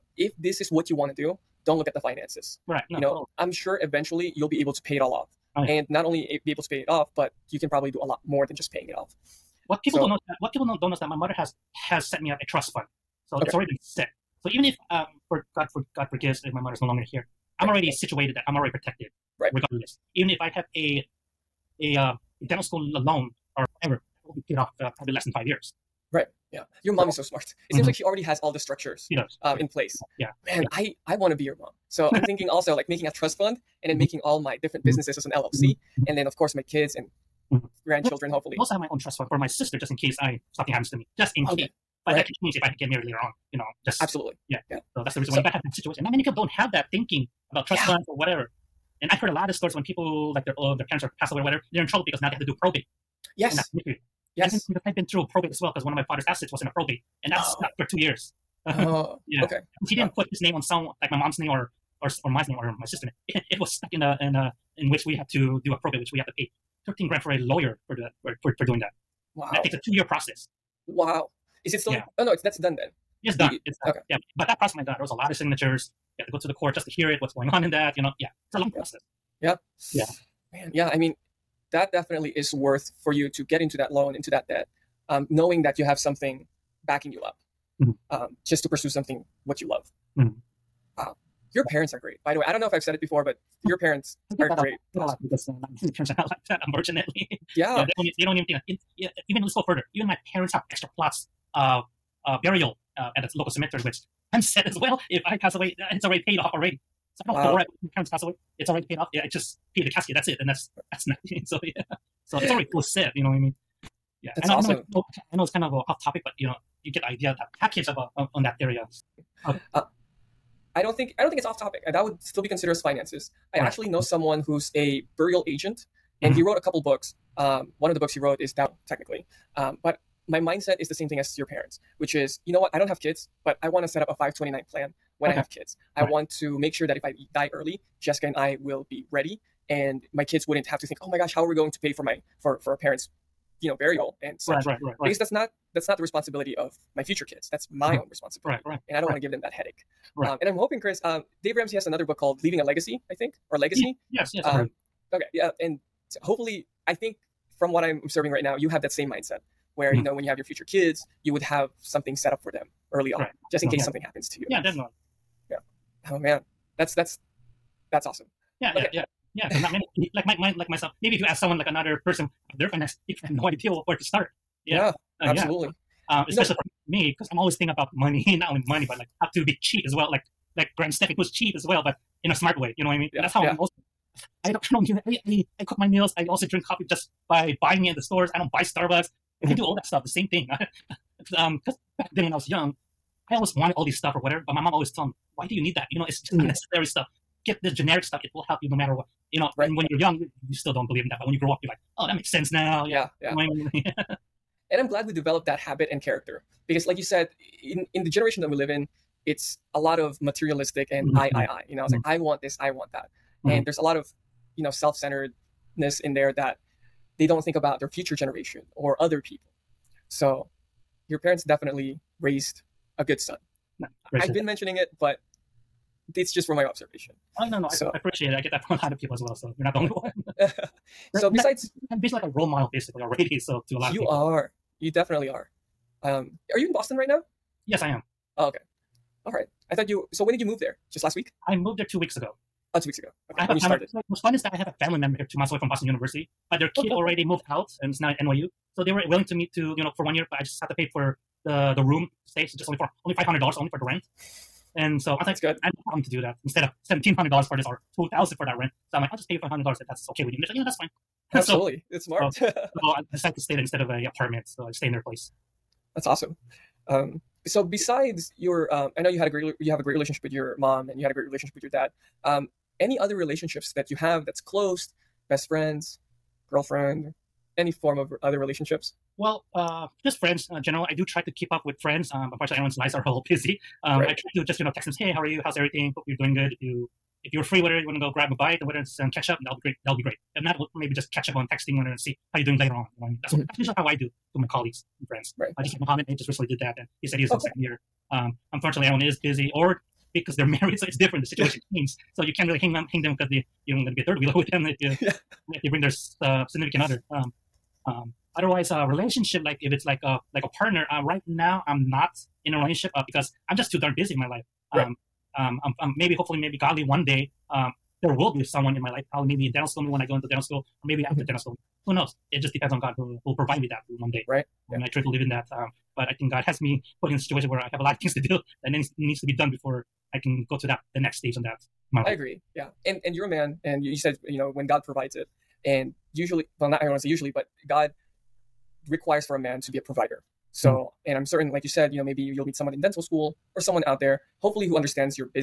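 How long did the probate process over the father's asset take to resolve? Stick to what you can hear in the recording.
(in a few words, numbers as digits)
2 years.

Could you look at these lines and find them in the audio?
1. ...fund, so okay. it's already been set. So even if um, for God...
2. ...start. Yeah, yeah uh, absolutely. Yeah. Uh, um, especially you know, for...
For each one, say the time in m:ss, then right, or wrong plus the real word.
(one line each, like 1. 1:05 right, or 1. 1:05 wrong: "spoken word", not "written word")
1. 0:12 right
2. 2:54 right.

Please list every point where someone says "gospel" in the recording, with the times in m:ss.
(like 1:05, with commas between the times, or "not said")
not said.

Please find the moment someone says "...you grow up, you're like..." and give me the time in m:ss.
3:21.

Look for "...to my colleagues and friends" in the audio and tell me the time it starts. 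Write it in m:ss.
4:54.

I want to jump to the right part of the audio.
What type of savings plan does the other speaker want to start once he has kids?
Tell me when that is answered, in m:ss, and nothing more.
2:14.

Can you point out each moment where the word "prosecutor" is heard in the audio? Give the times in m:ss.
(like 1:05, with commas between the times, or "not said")
not said.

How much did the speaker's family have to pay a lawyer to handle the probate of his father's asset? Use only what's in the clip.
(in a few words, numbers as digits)
$13,000.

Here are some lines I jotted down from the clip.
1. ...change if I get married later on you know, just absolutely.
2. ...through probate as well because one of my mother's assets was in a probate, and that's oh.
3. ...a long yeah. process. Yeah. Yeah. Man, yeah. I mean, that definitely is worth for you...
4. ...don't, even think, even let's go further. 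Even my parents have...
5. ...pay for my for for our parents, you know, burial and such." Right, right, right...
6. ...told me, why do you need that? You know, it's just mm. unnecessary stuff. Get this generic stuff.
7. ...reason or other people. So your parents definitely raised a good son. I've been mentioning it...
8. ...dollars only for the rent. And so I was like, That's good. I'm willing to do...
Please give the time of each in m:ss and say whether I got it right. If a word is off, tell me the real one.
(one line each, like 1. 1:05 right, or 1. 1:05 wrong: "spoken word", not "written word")
1. 0:42 right
2. 0:55 wrong: "father", not "mother"
3. 1:18 right
4. 1:38 right
5. 2:21 right
6. 3:14 right
7. 3:38 wrong: "generation", not "reason"
8. 4:13 right.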